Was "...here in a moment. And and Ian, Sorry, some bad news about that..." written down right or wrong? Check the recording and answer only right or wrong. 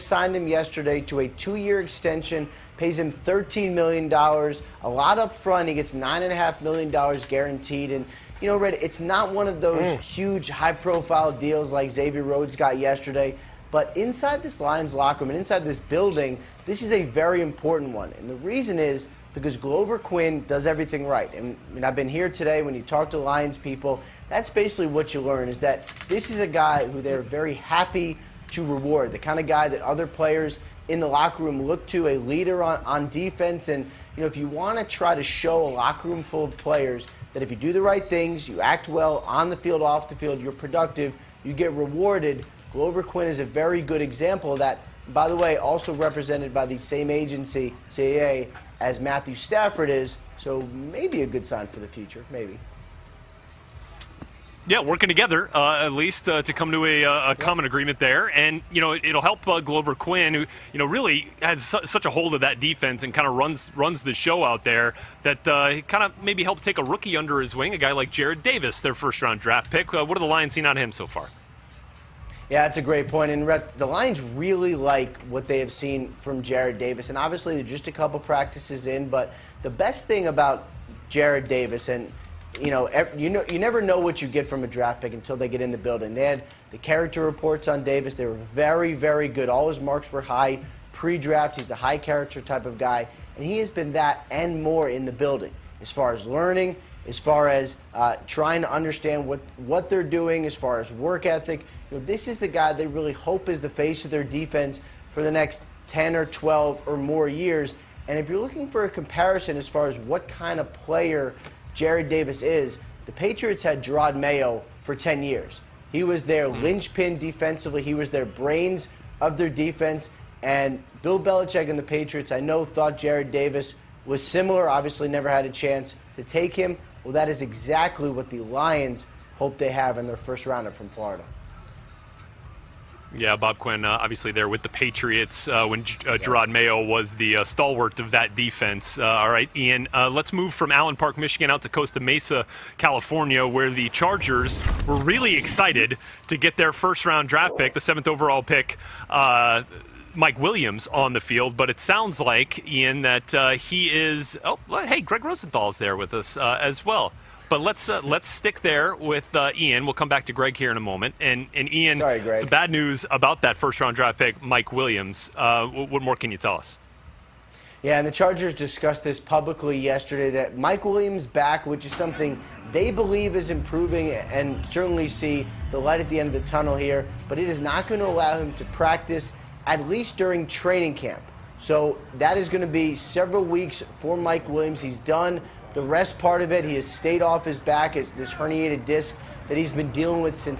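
right.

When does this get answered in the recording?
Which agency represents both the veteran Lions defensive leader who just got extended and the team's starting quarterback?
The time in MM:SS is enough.
00:47.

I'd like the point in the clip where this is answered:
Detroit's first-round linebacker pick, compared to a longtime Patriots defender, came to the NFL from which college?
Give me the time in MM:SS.
02:10.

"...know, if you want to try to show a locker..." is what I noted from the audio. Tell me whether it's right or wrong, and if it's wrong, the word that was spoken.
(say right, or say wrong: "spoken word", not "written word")
right.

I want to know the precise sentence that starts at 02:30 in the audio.
Mike Williams on the field, but it sounds like Ian that he is.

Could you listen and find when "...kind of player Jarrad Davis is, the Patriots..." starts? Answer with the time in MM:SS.
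01:50.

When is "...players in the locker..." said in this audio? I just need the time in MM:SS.
00:30.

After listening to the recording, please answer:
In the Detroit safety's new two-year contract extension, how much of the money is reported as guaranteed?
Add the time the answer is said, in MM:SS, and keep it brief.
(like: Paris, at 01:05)
$9.5 million, at 00:05.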